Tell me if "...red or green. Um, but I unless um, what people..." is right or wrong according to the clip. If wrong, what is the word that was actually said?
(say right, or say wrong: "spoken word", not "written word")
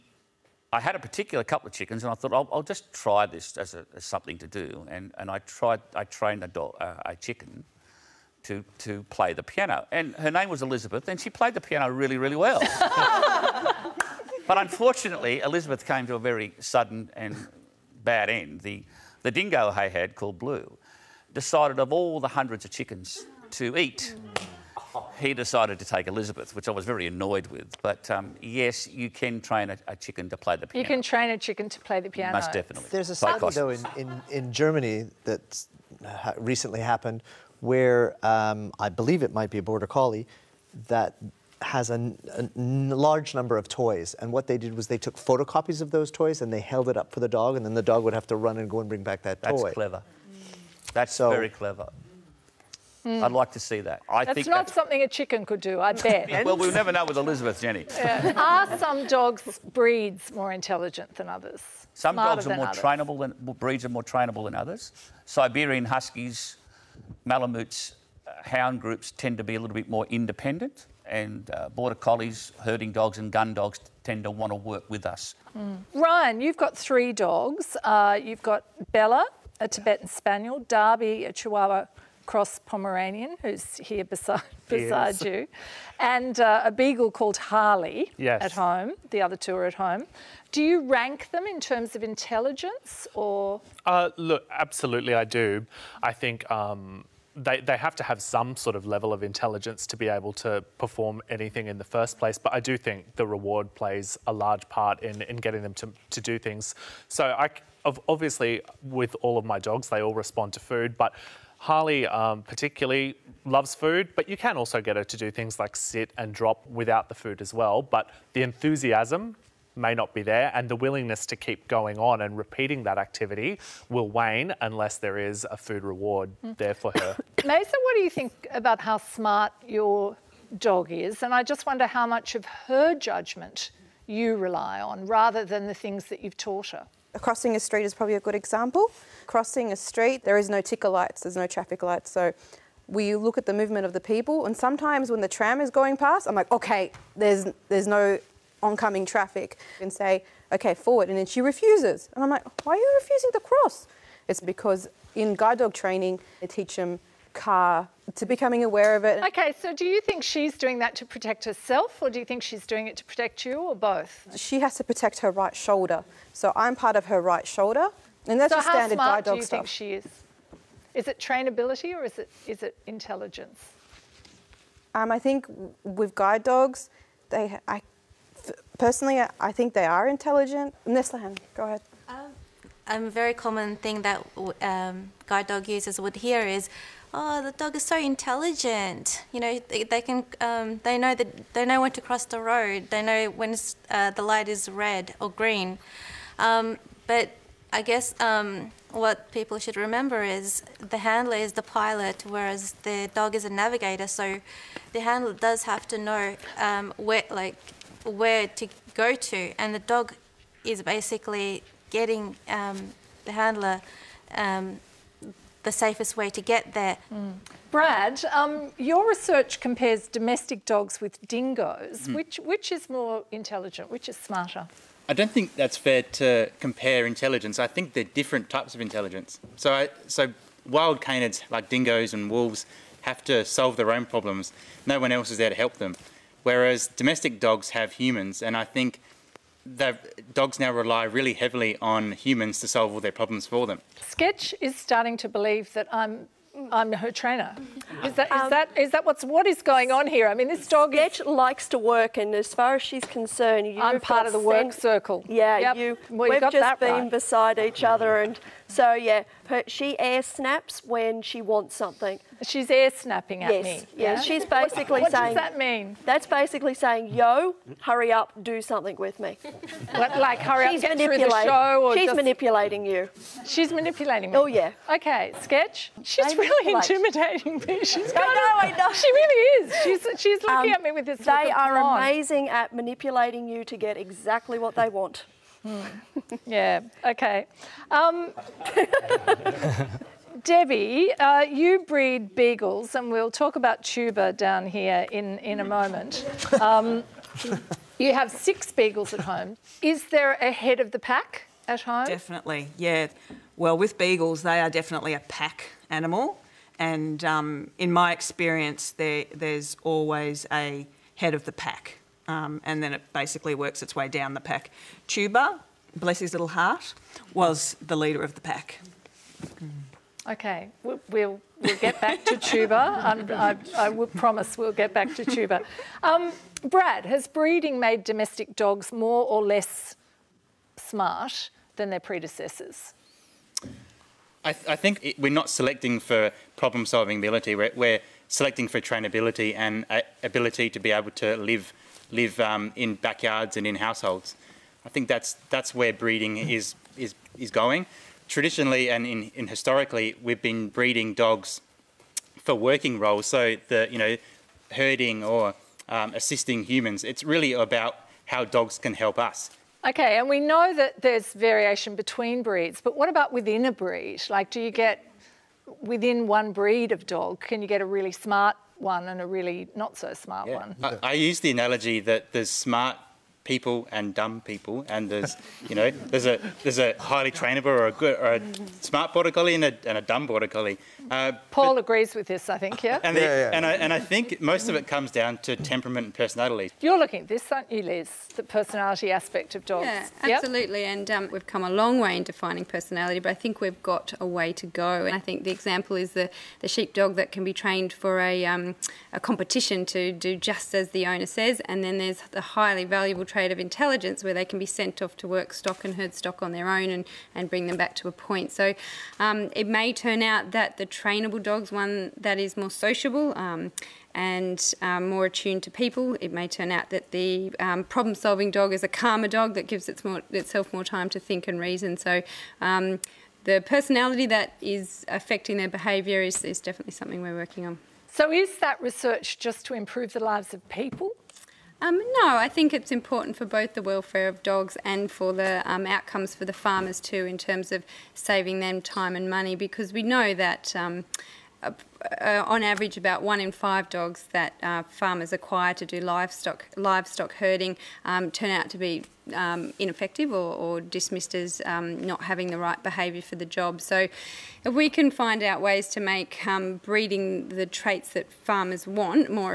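wrong: "guess", not "unless".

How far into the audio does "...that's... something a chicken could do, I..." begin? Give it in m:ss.
0:54.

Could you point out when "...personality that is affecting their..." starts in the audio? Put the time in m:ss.
7:03.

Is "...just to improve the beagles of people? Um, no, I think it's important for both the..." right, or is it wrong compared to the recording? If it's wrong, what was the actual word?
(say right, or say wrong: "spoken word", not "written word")
wrong: "lives", not "beagles".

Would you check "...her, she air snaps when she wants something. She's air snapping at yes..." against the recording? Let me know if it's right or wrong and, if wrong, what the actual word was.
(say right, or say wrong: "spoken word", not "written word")
right.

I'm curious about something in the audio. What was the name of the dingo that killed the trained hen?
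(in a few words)
Blue.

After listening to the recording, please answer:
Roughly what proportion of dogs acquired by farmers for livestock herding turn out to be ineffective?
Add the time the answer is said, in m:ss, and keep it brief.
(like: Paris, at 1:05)
1 in 5, at 7:23.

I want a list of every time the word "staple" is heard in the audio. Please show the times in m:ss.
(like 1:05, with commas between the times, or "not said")
not said.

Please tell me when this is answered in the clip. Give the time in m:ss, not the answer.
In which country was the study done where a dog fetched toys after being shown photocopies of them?
0:34.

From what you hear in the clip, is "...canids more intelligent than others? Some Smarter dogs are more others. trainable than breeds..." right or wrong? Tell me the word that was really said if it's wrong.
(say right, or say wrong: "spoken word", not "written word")
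wrong: "breeds", not "canids".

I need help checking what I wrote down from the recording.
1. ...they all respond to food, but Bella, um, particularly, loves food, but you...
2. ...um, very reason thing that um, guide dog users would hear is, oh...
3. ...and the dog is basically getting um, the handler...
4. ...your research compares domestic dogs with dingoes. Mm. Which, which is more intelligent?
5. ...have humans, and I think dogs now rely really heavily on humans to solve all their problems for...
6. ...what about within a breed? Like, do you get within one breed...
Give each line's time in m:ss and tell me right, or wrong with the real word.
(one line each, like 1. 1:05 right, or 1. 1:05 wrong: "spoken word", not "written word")
1. 1:49 wrong: "Harley", not "Bella"
2. 3:02 wrong: "common", not "reason"
3. 3:29 right
4. 3:38 right
5. 3:57 right
6. 6:02 right.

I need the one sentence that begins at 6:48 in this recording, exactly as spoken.
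So um, it may turn out that the trainable dog's one that is more sociable um, and um, more attuned to people.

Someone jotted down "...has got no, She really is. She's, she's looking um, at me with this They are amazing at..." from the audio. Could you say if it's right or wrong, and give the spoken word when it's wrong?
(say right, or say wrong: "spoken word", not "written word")
right.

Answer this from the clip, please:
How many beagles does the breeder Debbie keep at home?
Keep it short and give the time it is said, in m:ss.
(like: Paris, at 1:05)
6, at 4:58.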